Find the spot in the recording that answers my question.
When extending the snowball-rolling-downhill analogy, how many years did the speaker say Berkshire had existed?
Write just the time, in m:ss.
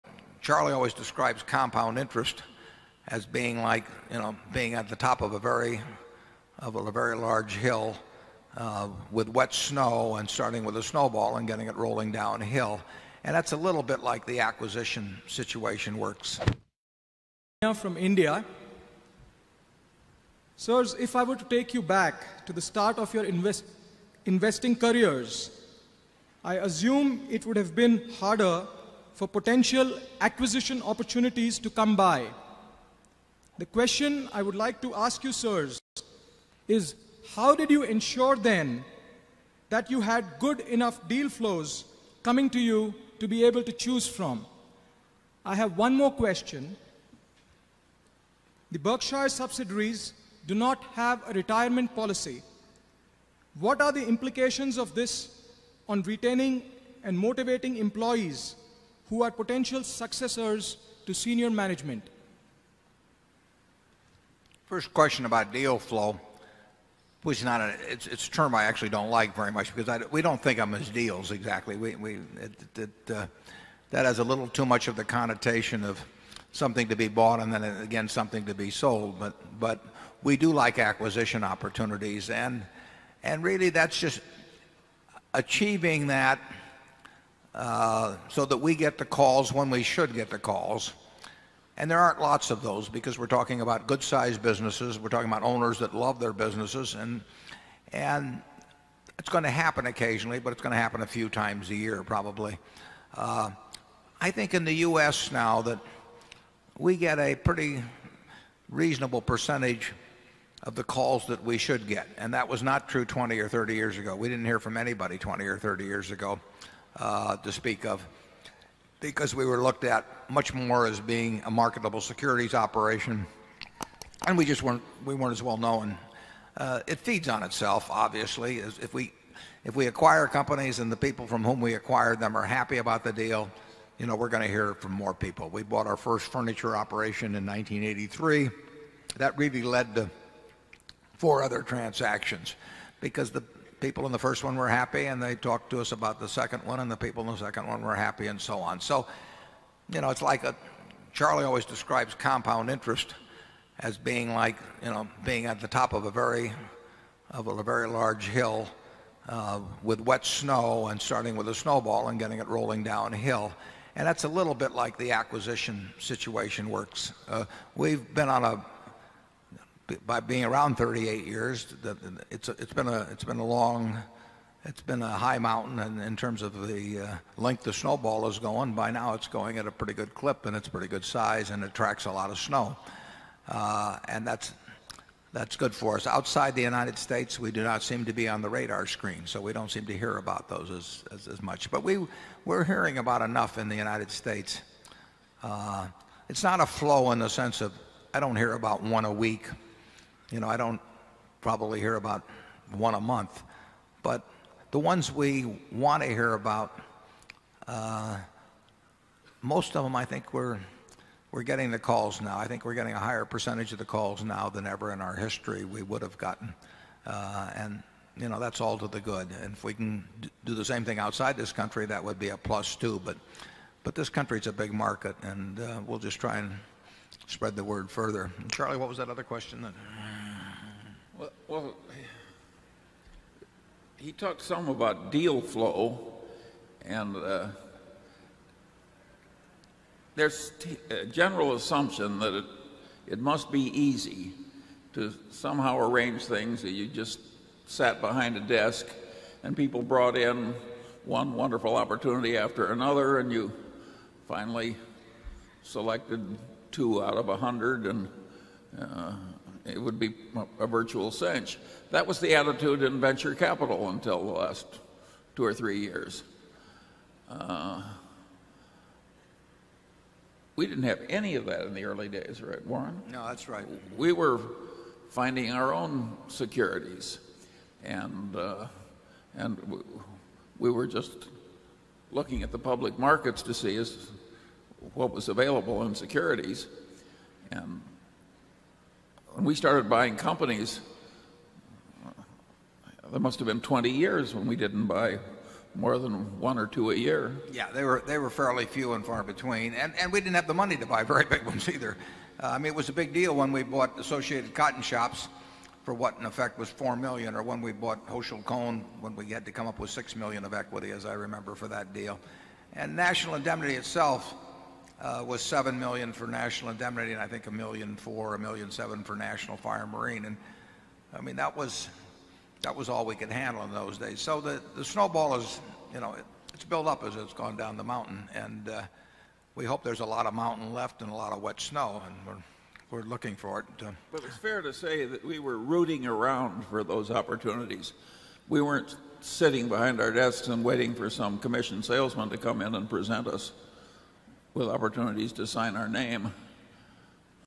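2:50.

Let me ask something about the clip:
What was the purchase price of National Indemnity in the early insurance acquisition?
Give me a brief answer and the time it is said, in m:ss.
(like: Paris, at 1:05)
$7 million, at 5:15.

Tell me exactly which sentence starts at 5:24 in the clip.
So the snowball is it's built up as it's gone down the mountain.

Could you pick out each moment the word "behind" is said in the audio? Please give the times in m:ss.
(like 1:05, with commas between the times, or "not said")
4:08, 5:39.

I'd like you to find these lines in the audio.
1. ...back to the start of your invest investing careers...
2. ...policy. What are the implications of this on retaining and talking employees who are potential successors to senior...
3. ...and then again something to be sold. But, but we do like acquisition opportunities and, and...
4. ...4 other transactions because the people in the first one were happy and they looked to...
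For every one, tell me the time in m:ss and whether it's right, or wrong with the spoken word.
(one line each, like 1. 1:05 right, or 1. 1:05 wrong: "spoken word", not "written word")
1. 0:21 right
2. 0:51 wrong: "motivating", not "talking"
3. 1:17 right
4. 2:21 wrong: "talked", not "looked".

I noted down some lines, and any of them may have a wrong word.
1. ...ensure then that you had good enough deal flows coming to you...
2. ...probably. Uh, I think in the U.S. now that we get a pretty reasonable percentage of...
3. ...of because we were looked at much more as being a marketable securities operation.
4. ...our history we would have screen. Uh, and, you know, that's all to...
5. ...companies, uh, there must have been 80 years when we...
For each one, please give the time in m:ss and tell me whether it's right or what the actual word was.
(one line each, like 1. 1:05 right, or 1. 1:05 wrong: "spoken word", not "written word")
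1. 0:37 right
2. 1:42 right
3. 1:57 right
4. 3:35 wrong: "gotten", not "screen"
5. 4:50 wrong: "20", not "80".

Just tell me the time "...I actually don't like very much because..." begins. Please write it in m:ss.
1:08.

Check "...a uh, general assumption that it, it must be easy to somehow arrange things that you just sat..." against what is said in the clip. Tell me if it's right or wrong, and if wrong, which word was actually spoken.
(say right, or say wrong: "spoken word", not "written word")
right.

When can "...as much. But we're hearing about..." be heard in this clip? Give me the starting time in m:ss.
3:11.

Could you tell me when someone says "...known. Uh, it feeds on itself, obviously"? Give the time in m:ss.
2:05.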